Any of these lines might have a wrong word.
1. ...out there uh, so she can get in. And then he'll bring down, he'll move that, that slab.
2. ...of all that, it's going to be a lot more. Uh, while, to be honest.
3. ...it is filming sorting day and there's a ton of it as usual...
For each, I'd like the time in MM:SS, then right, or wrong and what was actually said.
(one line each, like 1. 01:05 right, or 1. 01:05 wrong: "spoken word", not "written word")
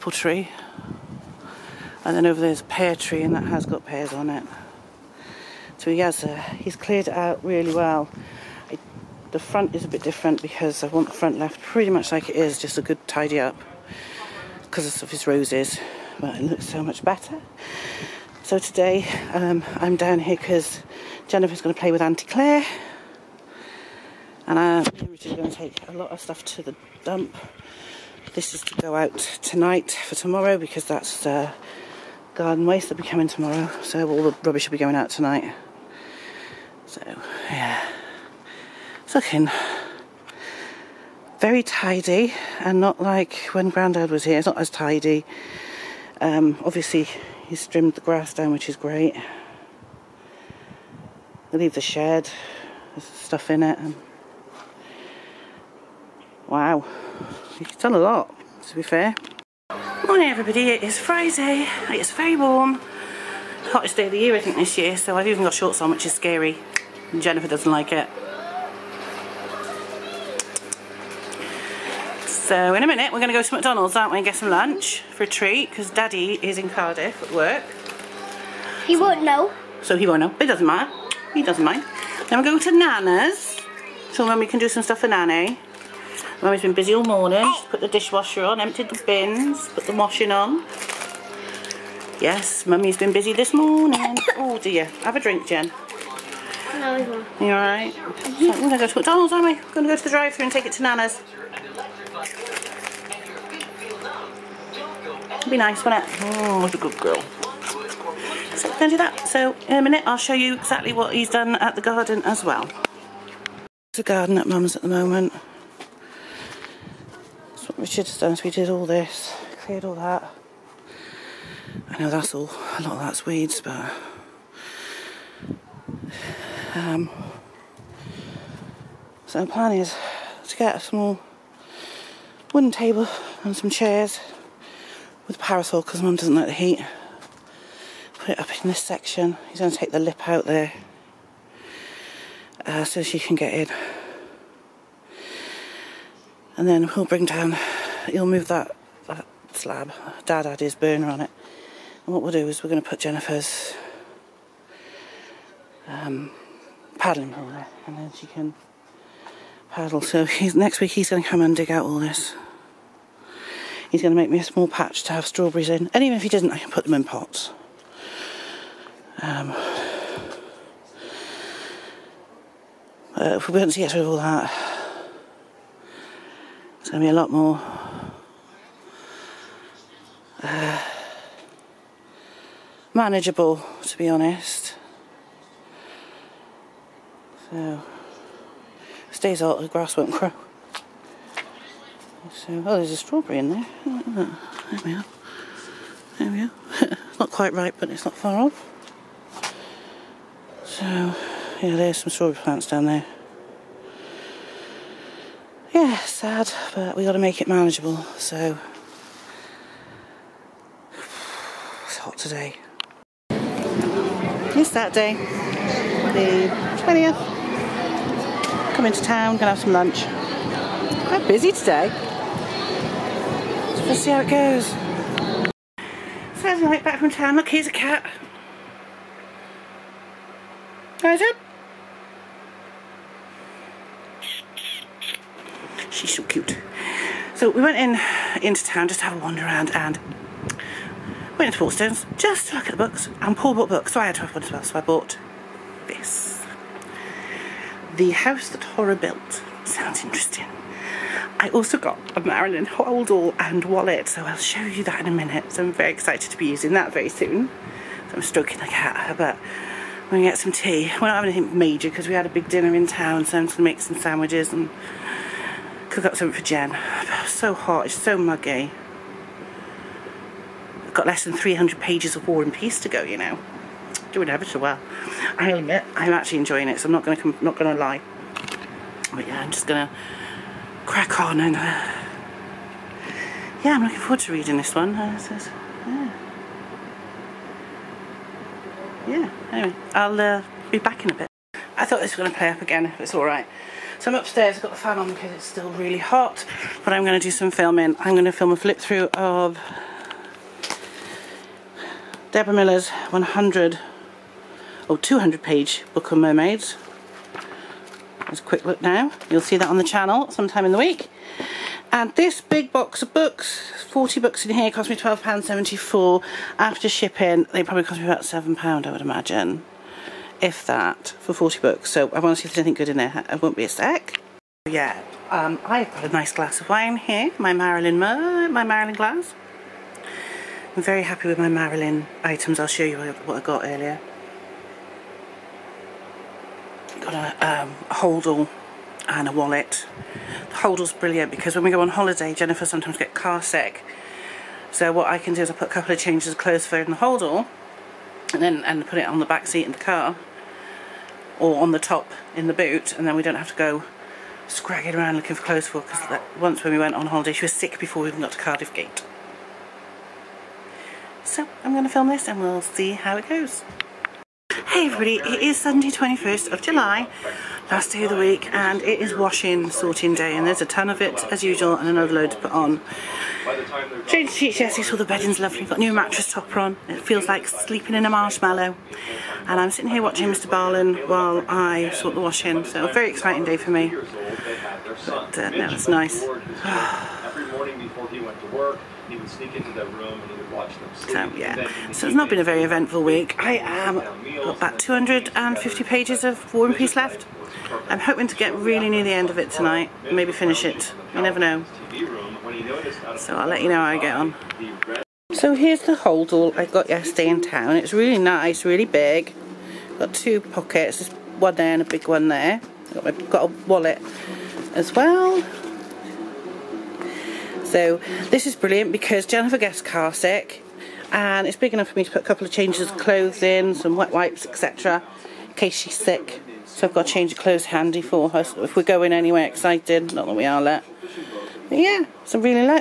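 1. 02:20 right
2. 02:54 wrong: "manageable", not "while"
3. 06:08 wrong: "washing", not "filming".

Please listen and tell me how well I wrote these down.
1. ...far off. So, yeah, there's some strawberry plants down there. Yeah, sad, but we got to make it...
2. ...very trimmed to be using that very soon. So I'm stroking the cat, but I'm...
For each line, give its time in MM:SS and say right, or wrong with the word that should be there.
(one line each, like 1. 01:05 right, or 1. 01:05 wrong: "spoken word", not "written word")
1. 03:18 right
2. 04:15 wrong: "excited", not "trimmed".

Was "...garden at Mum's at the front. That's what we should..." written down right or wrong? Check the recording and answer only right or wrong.
wrong.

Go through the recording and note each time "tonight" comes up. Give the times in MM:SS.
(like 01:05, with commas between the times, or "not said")
00:29, 00:35, 06:39.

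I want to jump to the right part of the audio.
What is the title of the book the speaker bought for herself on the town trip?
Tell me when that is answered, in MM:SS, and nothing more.
04:07.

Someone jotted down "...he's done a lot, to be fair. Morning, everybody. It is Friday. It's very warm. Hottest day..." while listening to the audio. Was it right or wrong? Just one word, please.
right.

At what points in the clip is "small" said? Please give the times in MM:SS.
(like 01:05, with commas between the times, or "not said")
02:10, 02:44.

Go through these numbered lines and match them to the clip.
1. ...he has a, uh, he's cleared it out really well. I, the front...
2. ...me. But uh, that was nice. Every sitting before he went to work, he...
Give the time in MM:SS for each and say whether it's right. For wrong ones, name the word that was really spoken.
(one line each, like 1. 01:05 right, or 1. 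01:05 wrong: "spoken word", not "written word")
1. 00:05 right
2. 06:23 wrong: "morning", not "sitting".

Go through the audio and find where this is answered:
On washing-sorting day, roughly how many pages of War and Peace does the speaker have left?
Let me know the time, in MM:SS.
06:34.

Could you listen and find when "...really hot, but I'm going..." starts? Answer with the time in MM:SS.
04:55.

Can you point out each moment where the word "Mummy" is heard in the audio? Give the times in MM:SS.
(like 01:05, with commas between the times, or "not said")
01:26, 01:32.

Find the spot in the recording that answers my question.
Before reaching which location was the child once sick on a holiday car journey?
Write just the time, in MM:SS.
05:58.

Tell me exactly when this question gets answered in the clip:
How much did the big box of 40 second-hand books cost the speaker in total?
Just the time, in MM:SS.
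05:14.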